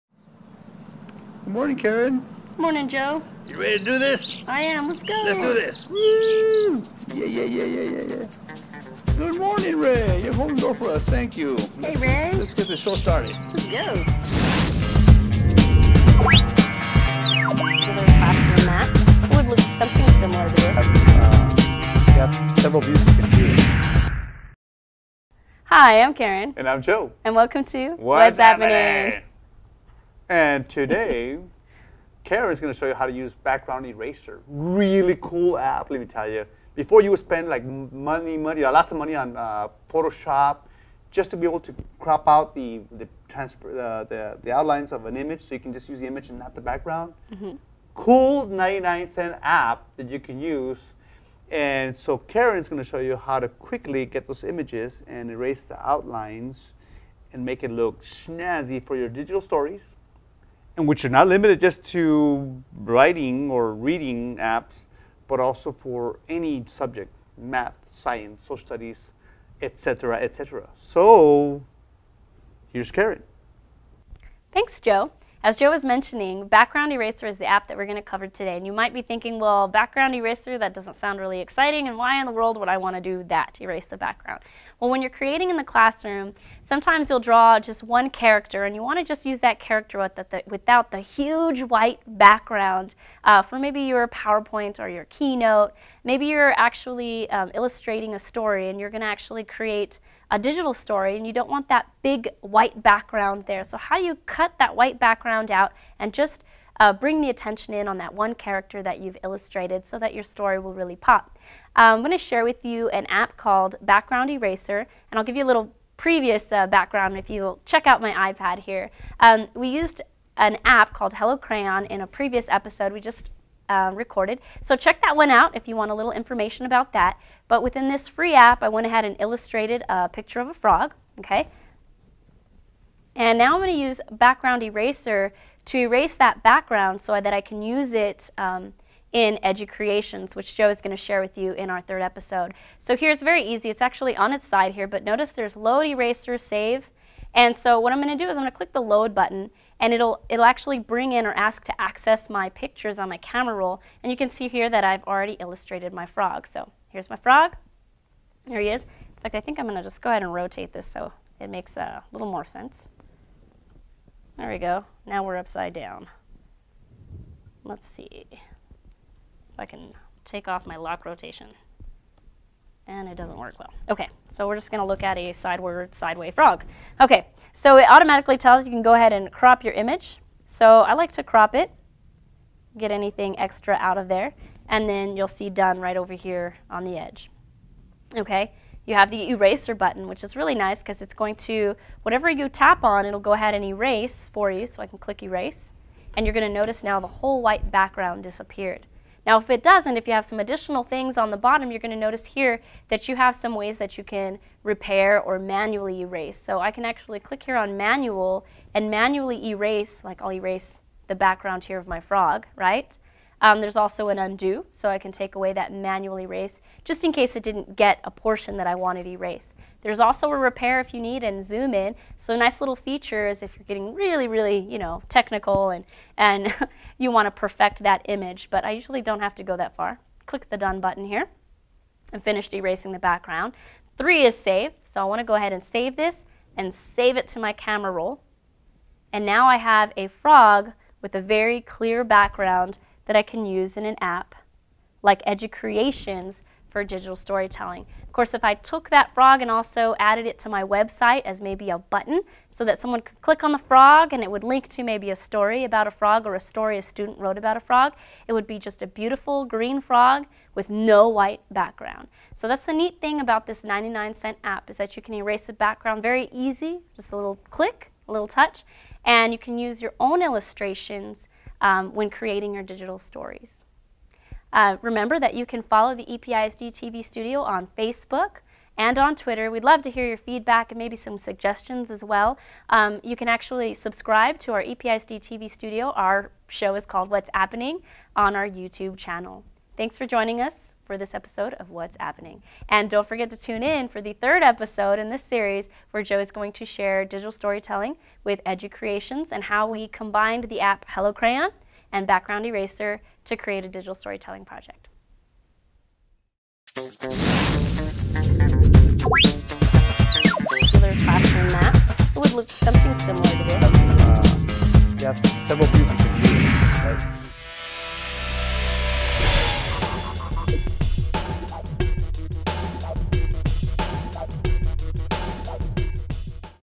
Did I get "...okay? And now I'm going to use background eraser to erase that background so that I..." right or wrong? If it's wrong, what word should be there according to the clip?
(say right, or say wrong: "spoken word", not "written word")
right.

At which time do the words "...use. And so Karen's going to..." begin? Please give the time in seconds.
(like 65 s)
50 s.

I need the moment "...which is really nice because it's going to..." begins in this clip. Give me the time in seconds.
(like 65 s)
190 s.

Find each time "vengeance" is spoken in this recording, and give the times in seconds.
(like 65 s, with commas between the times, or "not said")
not said.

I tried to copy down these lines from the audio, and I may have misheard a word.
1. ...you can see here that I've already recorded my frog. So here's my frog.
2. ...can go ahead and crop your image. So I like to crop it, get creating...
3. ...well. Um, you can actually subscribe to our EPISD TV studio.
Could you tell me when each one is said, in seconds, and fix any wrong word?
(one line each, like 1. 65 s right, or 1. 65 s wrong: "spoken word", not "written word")
1. 154 s wrong: "illustrated", not "recorded"
2. 178 s wrong: "anything", not "creating"
3. 282 s right.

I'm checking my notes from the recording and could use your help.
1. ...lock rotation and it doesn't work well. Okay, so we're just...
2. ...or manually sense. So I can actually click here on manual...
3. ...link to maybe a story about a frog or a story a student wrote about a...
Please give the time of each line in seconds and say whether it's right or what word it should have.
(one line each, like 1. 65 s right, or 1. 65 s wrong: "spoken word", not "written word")
1. 170 s right
2. 205 s wrong: "erase", not "sense"
3. 254 s right.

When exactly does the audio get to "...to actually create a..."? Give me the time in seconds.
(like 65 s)
99 s.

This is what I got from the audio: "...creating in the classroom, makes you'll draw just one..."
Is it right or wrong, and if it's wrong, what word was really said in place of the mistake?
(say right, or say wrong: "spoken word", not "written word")
wrong: "sometimes", not "makes".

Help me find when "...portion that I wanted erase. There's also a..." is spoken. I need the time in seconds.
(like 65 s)
218 s.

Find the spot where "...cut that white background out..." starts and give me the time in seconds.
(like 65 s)
104 s.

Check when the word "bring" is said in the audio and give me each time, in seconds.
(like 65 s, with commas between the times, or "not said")
106 s, 150 s.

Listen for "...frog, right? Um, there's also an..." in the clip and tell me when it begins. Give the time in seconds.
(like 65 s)
211 s.